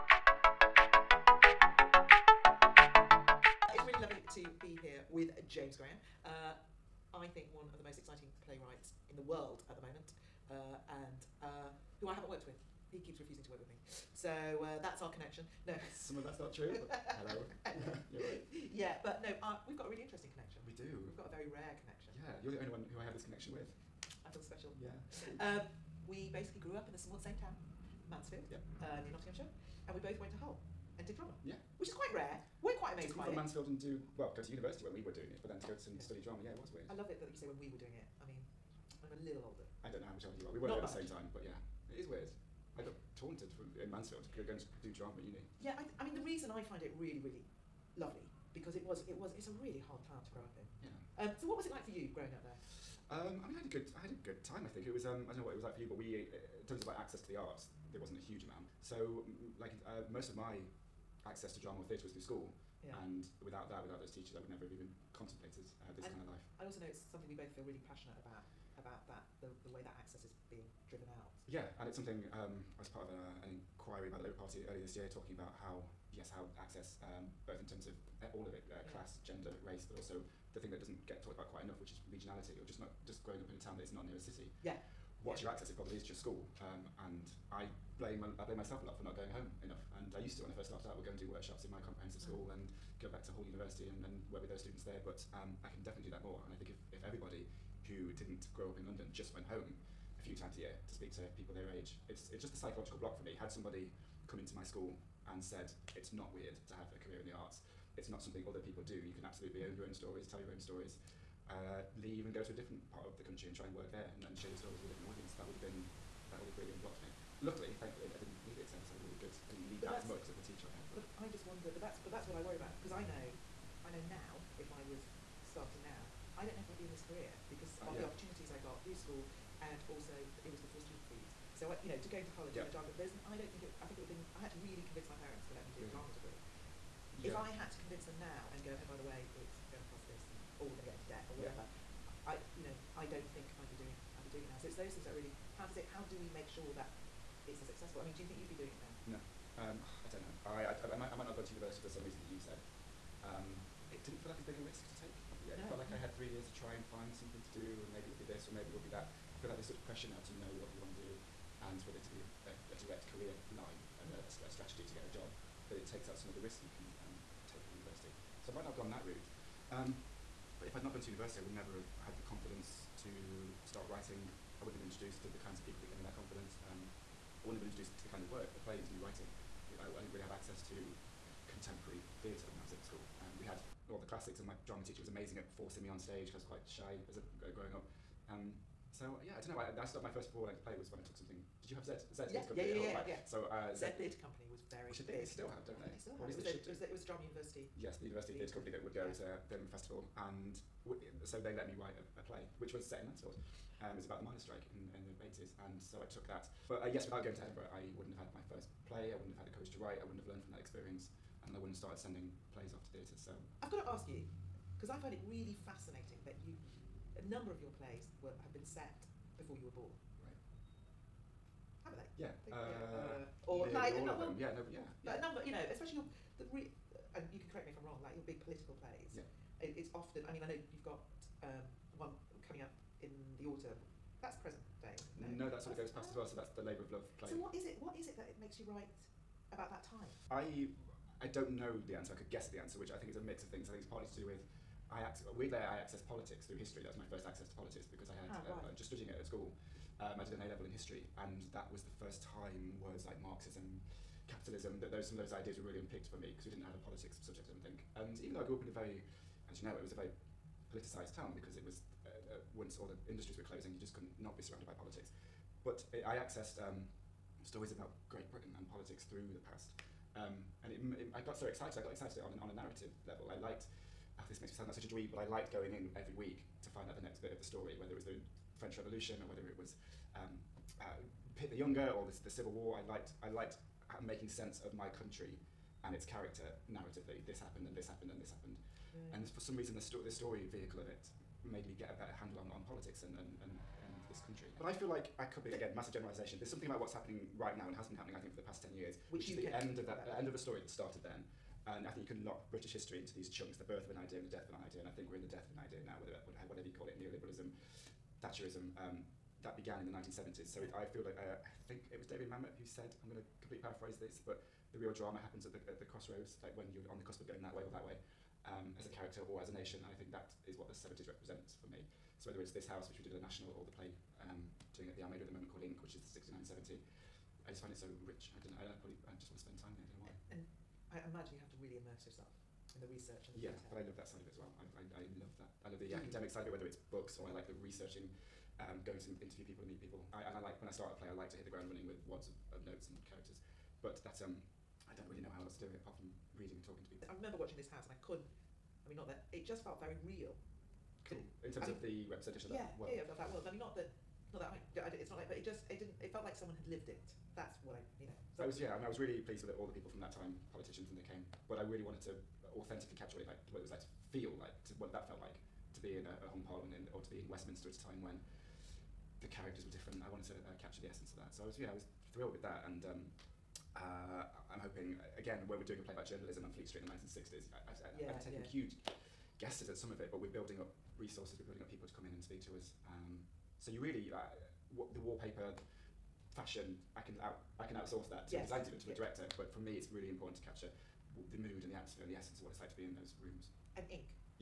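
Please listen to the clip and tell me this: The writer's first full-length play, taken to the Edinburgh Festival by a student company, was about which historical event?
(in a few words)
the miners' strike.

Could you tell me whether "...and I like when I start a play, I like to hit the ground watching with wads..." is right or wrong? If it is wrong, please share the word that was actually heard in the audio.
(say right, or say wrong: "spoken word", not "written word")
wrong: "running", not "watching".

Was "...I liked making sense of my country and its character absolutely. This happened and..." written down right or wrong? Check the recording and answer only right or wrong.
wrong.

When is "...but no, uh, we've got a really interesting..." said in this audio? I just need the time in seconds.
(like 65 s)
19 s.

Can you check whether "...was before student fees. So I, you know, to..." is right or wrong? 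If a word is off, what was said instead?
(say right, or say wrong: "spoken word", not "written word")
right.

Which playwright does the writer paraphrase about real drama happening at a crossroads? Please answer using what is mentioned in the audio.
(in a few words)
David Mamet.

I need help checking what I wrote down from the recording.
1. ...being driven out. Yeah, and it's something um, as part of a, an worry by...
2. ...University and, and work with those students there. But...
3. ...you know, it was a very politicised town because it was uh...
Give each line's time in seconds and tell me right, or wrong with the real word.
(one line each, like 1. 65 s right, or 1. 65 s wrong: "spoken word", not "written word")
1. 70 s wrong: "inquiry", not "worry"
2. 93 s right
3. 259 s right.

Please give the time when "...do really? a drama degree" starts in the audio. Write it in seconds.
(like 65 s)
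135 s.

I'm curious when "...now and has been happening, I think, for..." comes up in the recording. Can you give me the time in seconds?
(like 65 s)
297 s.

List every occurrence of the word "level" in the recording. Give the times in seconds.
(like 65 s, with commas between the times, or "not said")
250 s, 273 s.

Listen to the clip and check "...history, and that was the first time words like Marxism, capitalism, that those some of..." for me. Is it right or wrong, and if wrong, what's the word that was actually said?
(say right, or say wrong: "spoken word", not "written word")
right.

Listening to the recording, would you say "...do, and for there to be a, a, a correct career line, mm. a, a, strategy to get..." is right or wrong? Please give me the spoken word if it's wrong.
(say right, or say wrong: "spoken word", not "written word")
wrong: "direct", not "correct".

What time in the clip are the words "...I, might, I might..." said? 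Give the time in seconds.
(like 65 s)
150 s.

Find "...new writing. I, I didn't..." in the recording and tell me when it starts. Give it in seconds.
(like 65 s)
178 s.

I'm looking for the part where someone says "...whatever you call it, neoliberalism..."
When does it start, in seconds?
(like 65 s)
306 s.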